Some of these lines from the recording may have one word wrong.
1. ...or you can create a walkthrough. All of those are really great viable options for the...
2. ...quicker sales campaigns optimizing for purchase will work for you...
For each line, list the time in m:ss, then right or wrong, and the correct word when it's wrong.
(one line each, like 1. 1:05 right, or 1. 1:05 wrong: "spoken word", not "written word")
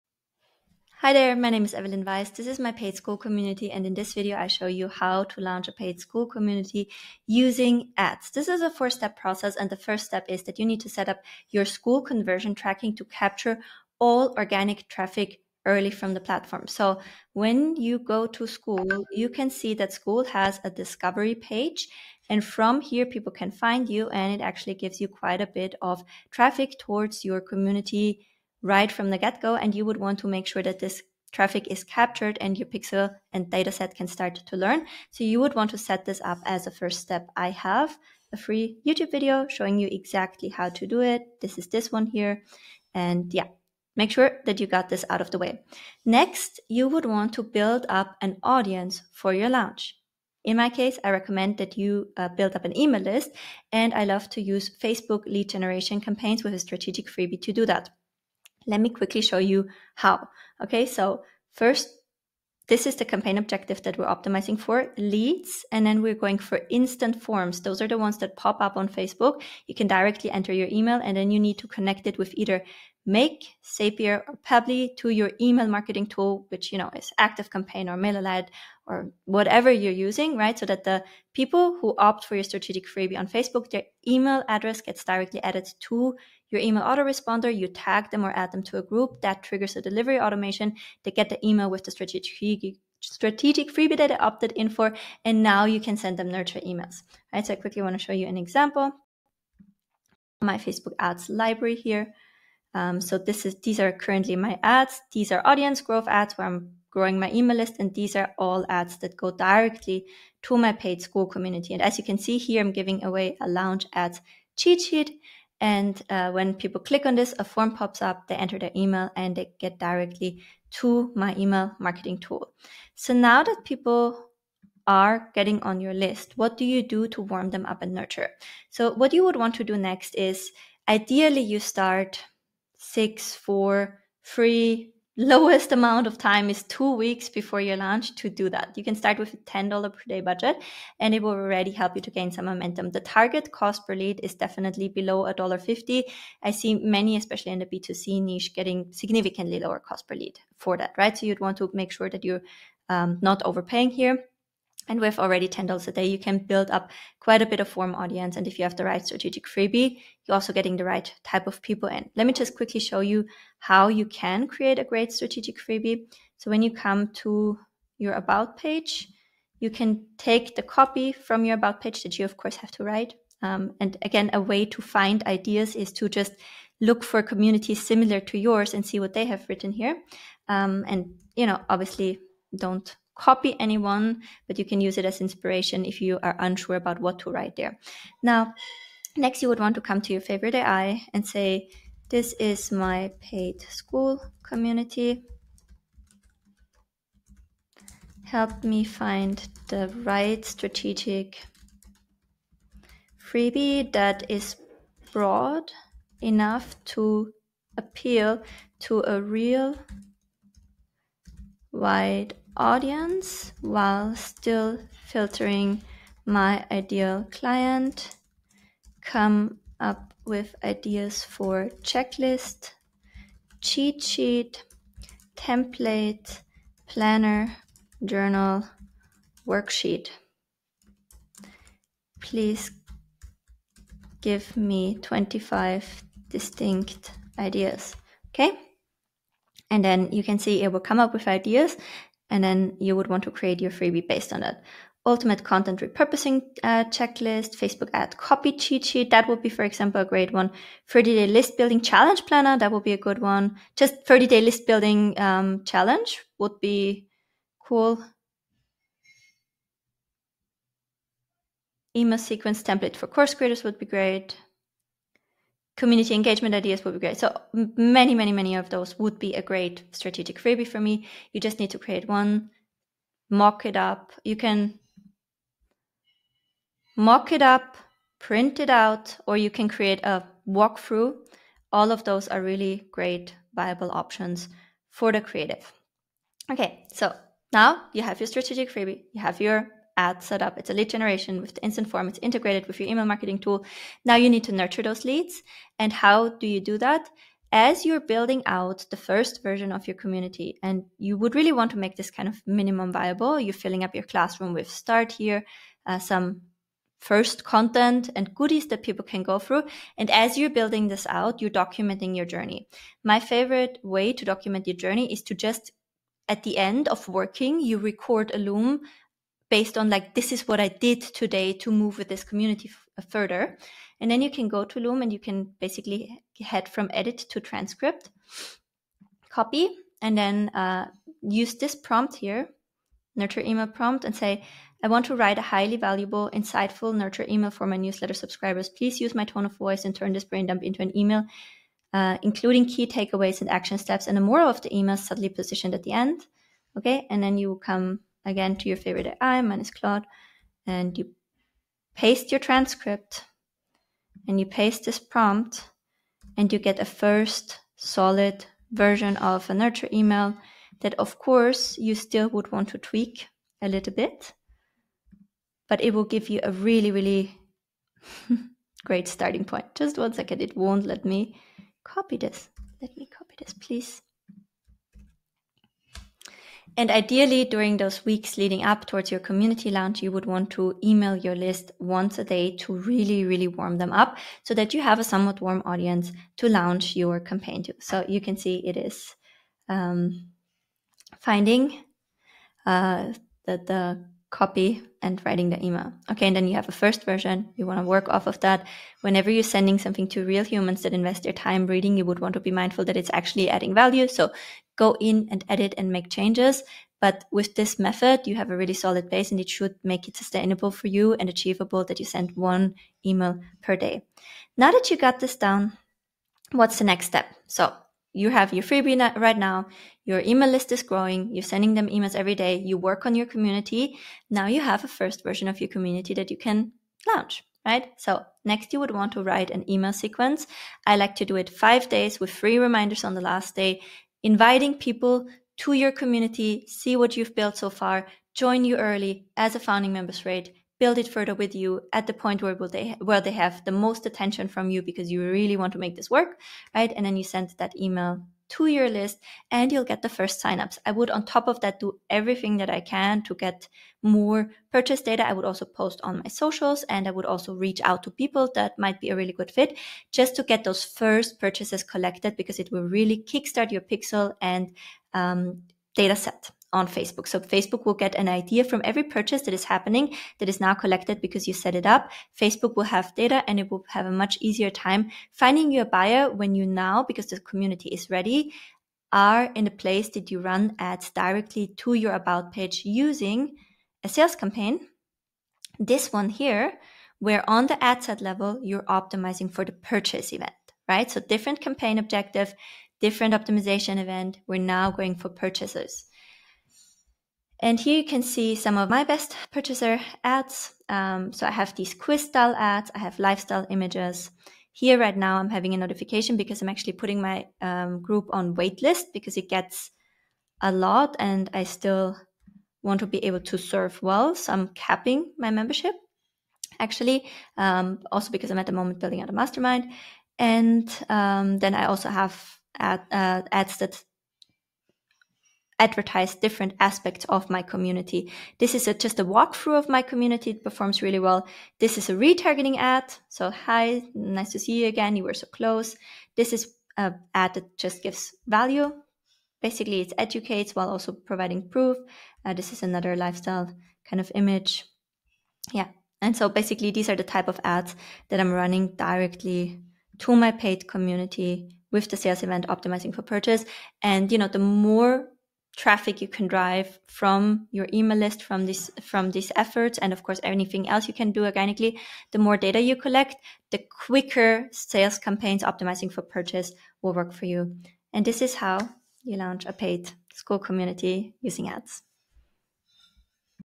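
1. 4:39 right
2. 9:24 right.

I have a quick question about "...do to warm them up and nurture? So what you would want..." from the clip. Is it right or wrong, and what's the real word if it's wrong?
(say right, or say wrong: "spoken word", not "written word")
right.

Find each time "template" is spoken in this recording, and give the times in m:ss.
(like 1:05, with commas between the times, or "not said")
3:45, 4:22.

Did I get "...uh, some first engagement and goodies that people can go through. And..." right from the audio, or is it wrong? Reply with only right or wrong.
wrong.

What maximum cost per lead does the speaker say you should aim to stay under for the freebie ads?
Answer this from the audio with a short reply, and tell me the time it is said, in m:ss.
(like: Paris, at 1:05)
$1.50, at 2:25.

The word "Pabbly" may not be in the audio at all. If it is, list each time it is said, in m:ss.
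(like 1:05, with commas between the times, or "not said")
1:14.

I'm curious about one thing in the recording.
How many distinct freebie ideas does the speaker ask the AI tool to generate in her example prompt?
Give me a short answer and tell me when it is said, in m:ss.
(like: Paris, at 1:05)
25, at 3:55.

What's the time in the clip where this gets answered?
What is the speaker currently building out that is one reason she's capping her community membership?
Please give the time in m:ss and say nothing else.
8:39.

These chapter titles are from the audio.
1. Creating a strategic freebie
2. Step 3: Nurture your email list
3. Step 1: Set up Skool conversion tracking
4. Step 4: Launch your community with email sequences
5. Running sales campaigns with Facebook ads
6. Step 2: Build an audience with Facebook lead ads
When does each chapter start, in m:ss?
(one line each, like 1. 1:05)
1. 2:32
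2. 4:46
3. 0:30
4. 6:56
5. 8:26
6. 1:02.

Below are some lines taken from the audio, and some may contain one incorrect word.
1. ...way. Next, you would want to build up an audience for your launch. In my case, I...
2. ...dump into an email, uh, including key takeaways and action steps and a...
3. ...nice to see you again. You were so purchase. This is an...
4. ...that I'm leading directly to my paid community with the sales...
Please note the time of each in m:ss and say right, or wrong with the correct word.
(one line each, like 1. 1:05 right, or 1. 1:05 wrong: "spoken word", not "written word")
1. 0:45 right
2. 5:40 right
3. 8:54 wrong: "close", not "purchase"
4. 9:08 wrong: "running", not "leading".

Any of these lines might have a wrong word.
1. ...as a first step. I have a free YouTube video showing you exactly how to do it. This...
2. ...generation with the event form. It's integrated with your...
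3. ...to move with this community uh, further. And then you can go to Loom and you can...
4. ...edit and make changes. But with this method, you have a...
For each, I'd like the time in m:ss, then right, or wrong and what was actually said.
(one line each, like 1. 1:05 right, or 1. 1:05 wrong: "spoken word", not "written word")
1. 0:36 right
2. 4:50 wrong: "instant", not "event"
3. 5:21 right
4. 6:45 right.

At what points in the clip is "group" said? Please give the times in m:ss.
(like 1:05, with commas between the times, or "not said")
1:28, 8:28.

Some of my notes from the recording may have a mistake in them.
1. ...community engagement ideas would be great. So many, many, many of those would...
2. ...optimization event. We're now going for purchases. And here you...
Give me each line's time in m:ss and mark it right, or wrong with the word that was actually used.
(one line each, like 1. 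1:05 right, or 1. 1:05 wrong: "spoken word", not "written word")
1. 4:25 right
2. 8:13 right.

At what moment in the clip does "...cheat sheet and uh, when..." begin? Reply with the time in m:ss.
1:54.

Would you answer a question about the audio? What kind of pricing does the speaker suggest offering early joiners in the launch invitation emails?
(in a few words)
founding member's rate.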